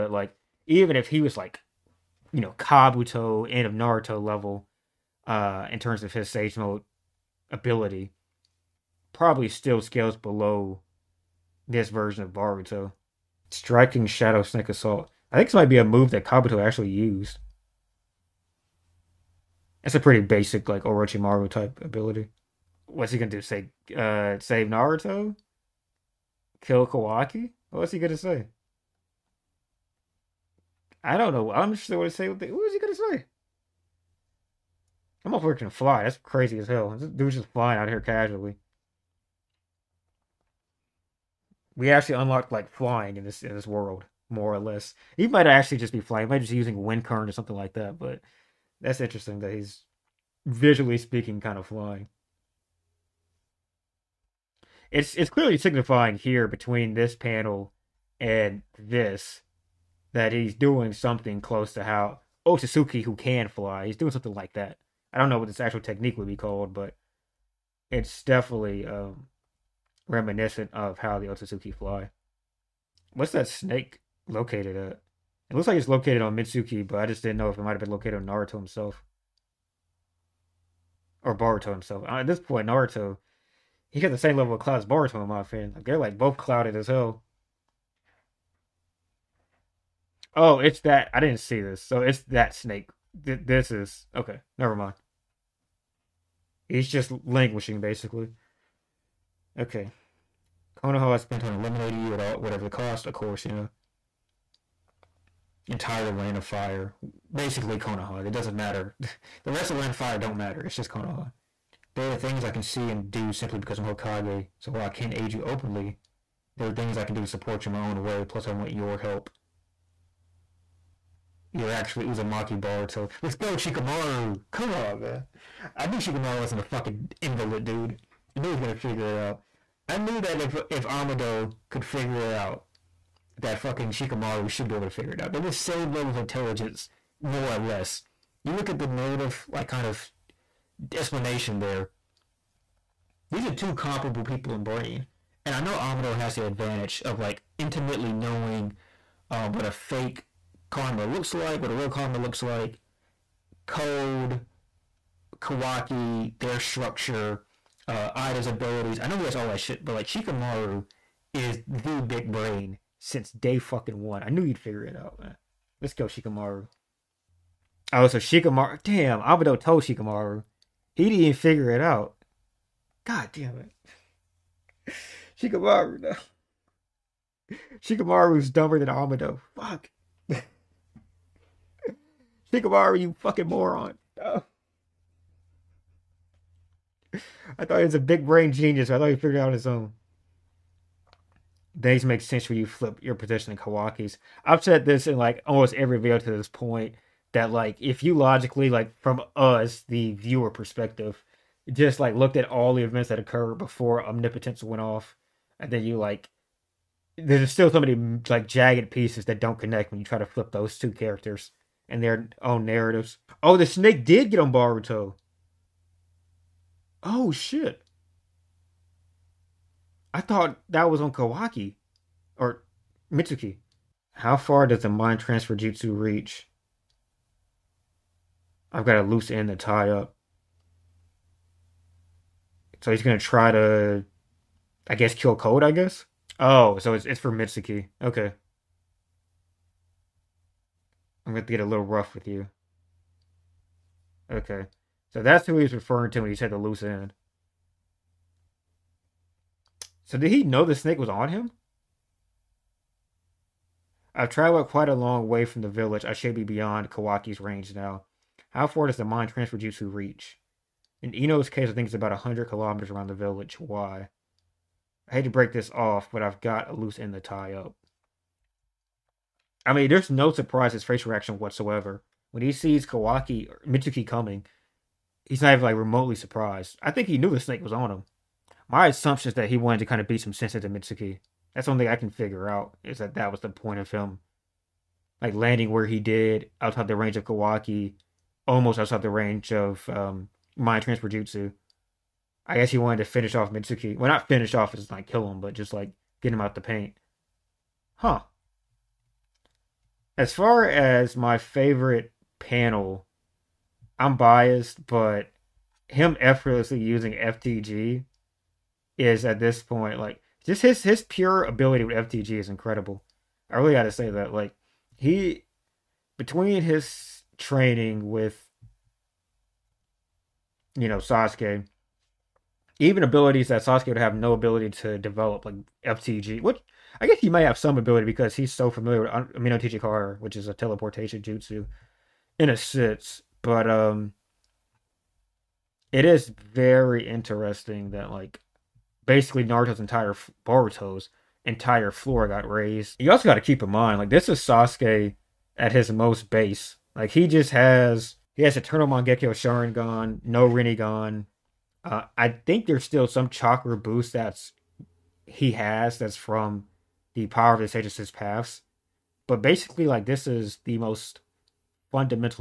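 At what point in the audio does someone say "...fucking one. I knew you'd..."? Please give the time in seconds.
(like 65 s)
163 s.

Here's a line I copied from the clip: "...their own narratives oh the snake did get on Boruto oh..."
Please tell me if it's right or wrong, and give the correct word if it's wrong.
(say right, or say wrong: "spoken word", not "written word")
right.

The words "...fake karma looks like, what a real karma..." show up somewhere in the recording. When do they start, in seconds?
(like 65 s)
149 s.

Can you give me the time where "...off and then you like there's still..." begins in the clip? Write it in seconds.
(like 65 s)
204 s.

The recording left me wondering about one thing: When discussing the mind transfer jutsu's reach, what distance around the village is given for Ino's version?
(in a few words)
100 kilometers.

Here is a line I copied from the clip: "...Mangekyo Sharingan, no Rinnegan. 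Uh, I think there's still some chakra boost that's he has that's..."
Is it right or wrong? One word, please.
right.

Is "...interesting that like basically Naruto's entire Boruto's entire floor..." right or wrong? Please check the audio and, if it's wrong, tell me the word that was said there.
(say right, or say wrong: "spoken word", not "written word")
right.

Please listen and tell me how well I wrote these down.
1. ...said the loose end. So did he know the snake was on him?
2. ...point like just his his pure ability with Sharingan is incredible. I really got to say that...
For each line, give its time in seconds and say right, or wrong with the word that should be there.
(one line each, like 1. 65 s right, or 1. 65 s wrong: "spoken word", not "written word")
1. 246 s right
2. 309 s wrong: "FTG", not "Sharingan".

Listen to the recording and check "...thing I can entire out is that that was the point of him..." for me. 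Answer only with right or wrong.
wrong.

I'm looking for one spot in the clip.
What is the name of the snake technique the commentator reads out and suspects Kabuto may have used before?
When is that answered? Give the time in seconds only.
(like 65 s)
13 s.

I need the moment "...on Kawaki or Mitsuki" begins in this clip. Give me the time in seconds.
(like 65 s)
221 s.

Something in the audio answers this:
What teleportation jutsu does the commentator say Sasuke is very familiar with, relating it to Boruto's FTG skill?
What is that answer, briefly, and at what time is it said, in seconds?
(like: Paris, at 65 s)
Amenotejikara, at 329 s.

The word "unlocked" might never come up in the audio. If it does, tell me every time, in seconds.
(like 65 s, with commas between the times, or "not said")
42 s.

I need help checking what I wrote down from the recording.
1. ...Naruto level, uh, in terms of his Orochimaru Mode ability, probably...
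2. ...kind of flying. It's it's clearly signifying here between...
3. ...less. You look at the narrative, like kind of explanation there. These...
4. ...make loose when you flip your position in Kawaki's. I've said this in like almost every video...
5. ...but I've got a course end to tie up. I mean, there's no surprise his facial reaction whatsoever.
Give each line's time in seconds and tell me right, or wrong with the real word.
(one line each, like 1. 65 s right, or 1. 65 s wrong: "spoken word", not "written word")
1. 3 s wrong: "Sage", not "Orochimaru"
2. 51 s right
3. 137 s right
4. 192 s wrong: "sense", not "loose"
5. 266 s wrong: "loose", not "course".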